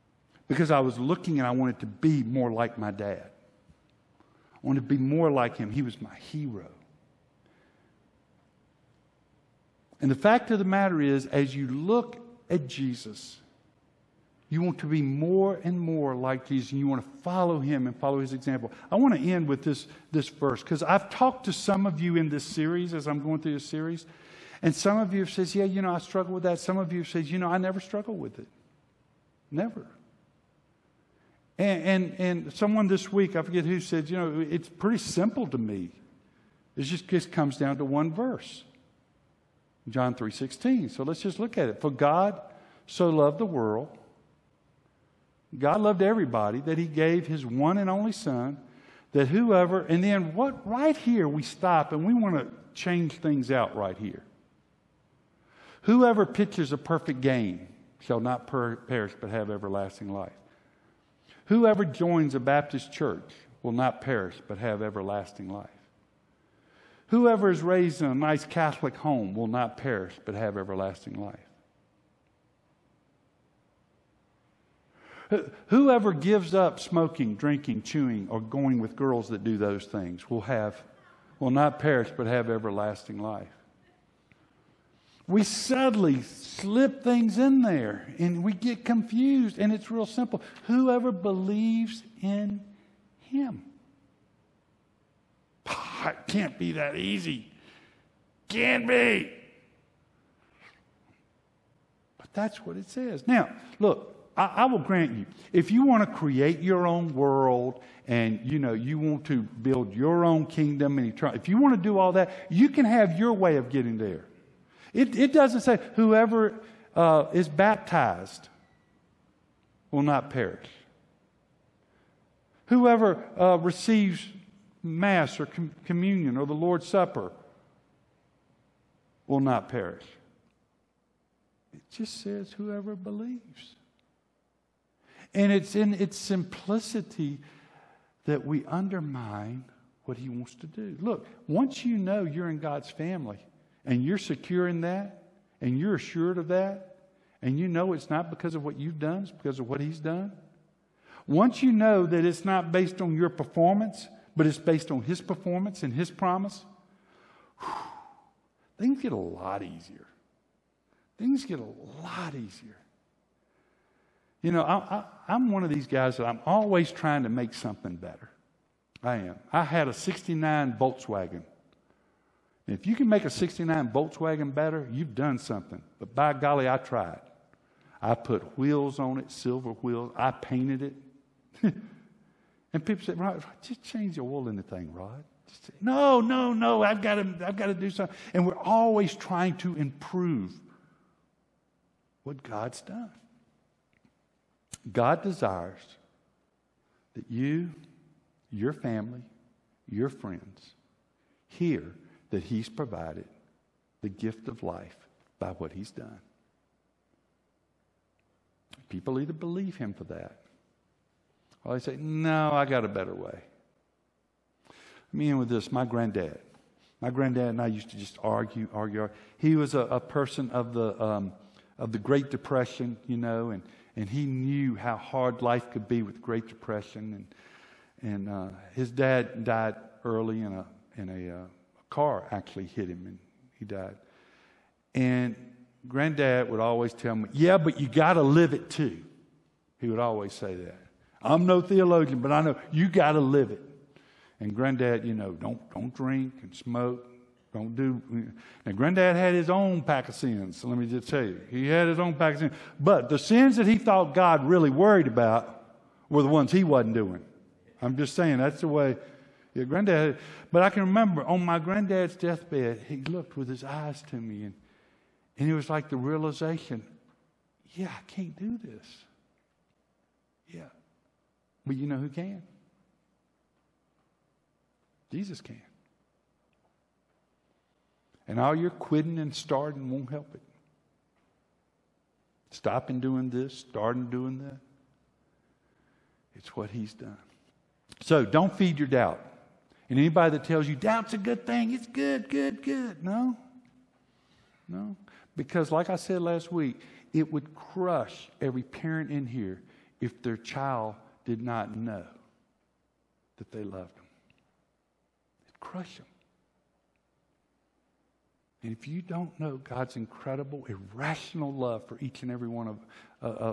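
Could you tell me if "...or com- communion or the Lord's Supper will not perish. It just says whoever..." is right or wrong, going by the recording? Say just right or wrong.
right.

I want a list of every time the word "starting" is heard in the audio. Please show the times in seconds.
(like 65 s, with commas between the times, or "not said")
279 s, 283 s.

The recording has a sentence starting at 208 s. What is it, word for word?
People either believe Him for that or they say, No, I got a better way.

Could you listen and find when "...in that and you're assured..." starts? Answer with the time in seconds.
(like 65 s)
144 s.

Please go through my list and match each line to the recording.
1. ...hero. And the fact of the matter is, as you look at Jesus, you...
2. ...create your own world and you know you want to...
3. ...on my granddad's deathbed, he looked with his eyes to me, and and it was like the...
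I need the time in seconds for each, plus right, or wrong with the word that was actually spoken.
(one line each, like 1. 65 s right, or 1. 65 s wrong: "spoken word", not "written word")
1. 6 s right
2. 106 s right
3. 261 s right.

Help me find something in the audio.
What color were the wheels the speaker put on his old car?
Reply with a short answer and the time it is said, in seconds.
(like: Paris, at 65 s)
Silver, at 179 s.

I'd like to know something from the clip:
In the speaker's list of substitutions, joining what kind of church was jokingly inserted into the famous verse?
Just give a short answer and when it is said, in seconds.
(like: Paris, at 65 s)
Baptist, at 62 s.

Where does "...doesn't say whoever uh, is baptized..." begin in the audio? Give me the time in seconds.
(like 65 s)
115 s.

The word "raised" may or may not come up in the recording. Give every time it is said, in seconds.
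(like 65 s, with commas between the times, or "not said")
67 s.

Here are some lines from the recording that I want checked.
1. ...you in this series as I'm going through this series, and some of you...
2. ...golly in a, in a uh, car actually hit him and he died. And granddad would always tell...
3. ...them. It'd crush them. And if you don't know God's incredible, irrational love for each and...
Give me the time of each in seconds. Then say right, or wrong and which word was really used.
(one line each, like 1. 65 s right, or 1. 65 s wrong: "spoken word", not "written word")
1. 21 s right
2. 230 s wrong: "early", not "golly"
3. 303 s right.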